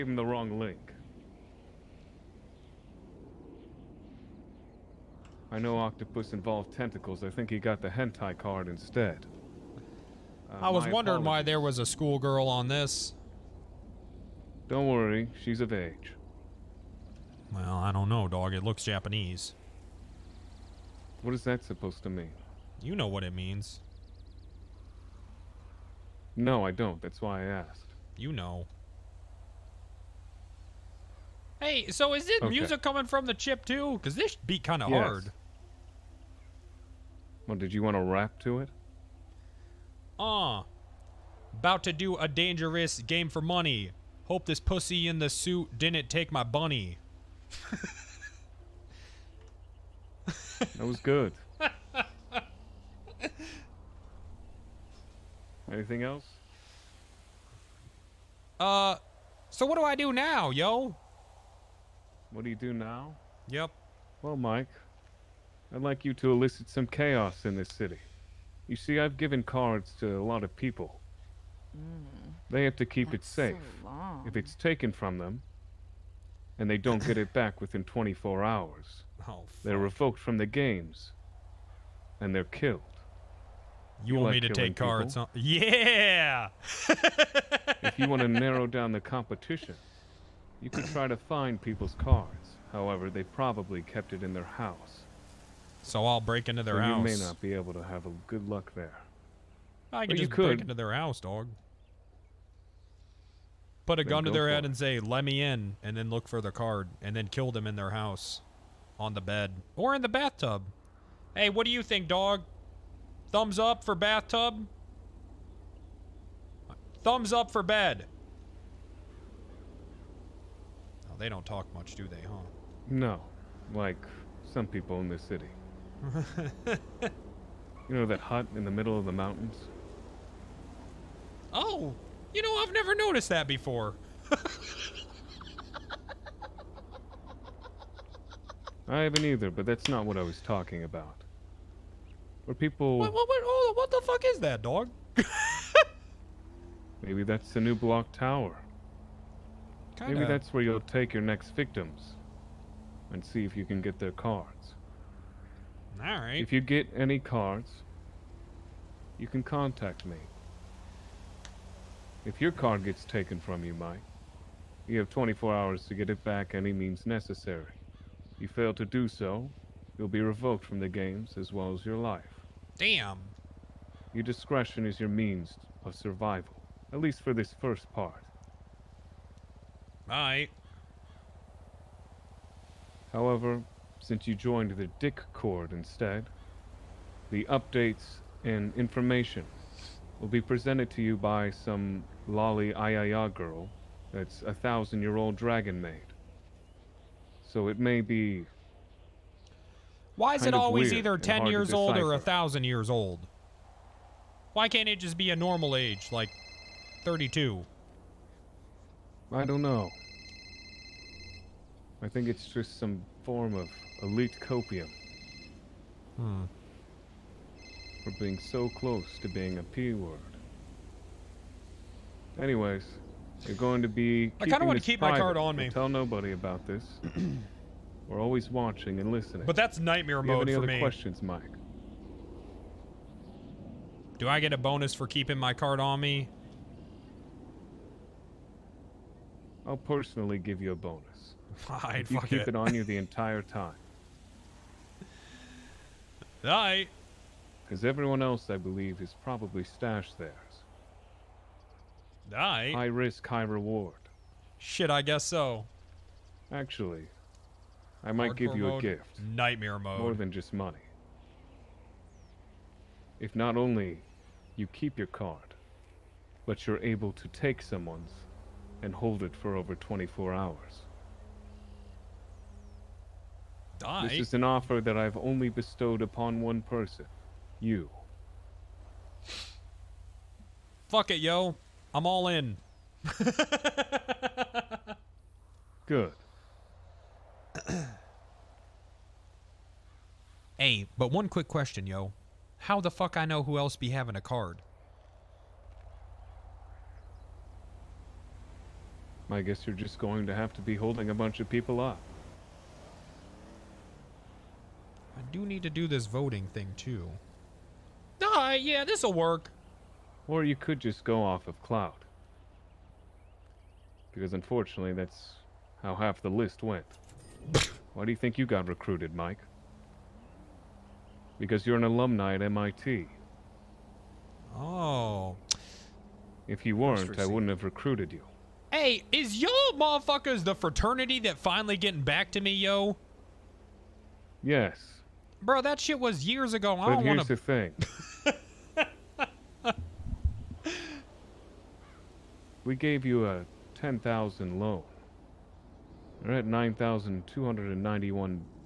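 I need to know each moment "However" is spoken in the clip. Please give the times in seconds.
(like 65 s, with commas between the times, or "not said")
92 s, 183 s.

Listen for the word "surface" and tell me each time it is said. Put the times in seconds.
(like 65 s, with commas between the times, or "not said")
not said.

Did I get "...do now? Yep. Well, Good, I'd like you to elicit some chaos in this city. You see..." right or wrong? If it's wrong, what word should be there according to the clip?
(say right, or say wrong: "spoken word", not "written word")
wrong: "Mike", not "Good".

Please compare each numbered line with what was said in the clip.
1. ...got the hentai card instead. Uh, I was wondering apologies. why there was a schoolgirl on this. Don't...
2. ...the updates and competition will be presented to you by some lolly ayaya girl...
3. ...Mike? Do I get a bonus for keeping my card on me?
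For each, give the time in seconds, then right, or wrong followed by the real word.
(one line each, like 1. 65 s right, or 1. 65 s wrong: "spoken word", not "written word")
1. 7 s right
2. 187 s wrong: "information", not "competition"
3. 231 s right.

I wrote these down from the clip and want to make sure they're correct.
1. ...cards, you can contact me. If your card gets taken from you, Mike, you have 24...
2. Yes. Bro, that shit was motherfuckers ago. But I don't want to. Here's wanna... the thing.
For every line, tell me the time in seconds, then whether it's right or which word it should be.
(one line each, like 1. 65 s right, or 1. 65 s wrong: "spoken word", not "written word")
1. 157 s right
2. 334 s wrong: "years", not "motherfuckers".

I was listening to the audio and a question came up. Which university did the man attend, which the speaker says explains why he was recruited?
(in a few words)
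MIT.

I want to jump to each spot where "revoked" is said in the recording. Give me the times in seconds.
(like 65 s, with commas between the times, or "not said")
79 s, 170 s.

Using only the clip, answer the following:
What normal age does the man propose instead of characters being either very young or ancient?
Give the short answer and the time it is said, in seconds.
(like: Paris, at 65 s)
32, at 207 s.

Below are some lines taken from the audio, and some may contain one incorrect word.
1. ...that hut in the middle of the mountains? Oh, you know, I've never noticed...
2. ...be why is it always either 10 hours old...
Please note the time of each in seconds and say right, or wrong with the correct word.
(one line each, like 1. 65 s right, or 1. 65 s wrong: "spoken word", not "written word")
1. 128 s right
2. 198 s wrong: "years", not "hours".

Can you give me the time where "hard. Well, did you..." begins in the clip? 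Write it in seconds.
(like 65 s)
35 s.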